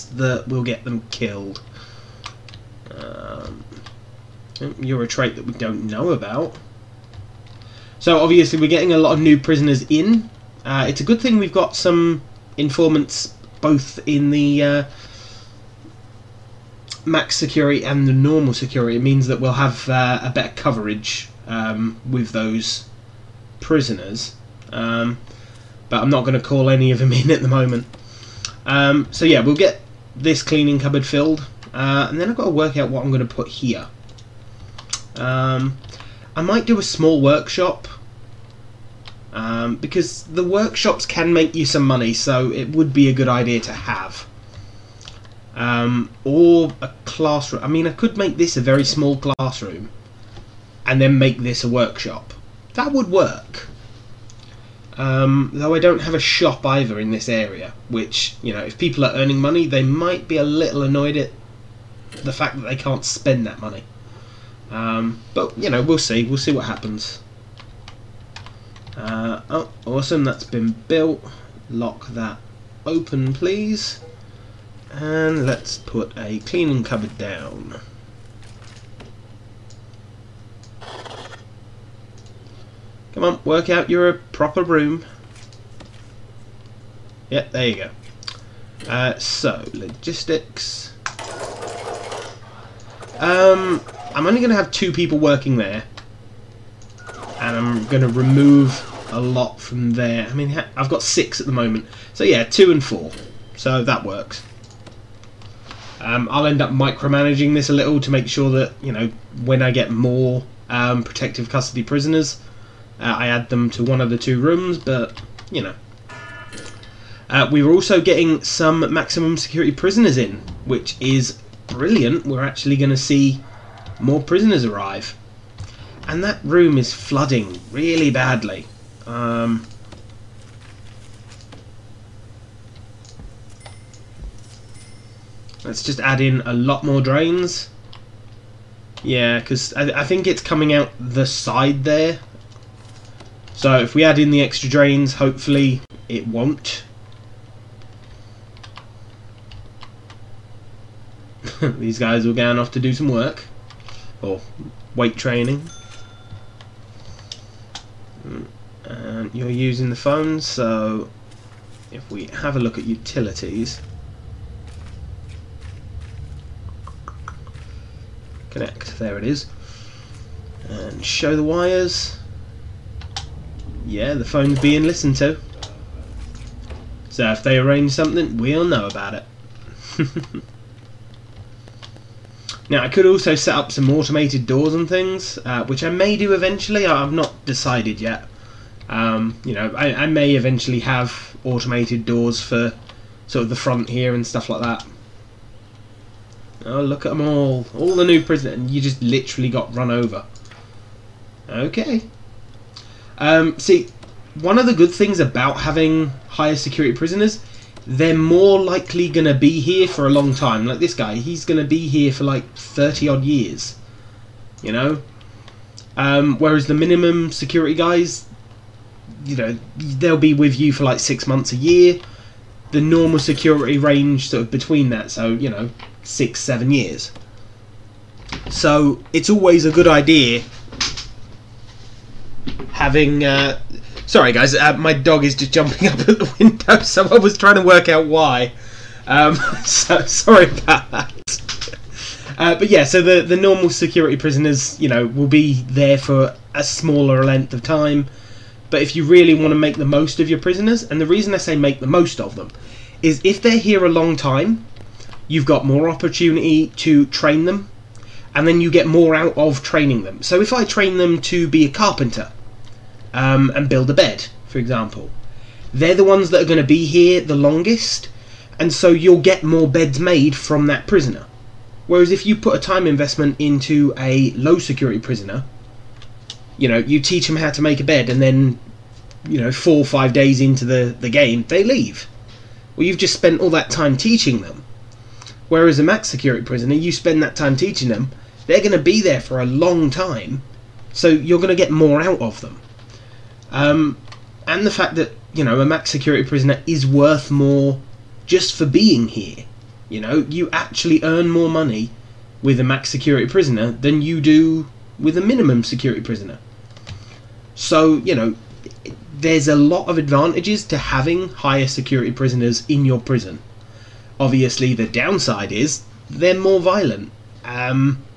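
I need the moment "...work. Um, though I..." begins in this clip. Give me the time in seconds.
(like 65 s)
53 s.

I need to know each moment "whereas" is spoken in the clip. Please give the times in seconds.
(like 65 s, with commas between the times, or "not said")
216 s, 271 s, 285 s.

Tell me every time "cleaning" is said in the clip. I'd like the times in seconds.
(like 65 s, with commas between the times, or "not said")
30 s, 76 s.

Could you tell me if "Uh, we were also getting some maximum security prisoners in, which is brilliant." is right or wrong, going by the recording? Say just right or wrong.
right.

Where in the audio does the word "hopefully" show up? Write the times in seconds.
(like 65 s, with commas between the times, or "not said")
145 s.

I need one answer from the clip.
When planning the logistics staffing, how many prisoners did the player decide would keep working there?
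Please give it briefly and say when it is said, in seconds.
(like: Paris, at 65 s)
2, at 94 s.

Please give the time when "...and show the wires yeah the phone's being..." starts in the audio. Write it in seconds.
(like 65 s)
170 s.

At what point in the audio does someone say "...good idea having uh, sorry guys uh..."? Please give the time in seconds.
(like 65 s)
229 s.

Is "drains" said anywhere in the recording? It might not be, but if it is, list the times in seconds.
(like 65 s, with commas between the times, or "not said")
137 s, 144 s.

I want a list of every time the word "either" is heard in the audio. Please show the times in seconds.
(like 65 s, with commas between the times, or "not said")
56 s.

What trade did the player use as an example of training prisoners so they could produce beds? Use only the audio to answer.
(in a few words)
carpenter.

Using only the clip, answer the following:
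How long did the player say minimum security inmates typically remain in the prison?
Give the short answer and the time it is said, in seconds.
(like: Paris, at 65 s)
six months a year, at 220 s.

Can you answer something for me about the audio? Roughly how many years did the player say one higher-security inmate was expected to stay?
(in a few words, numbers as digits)
30.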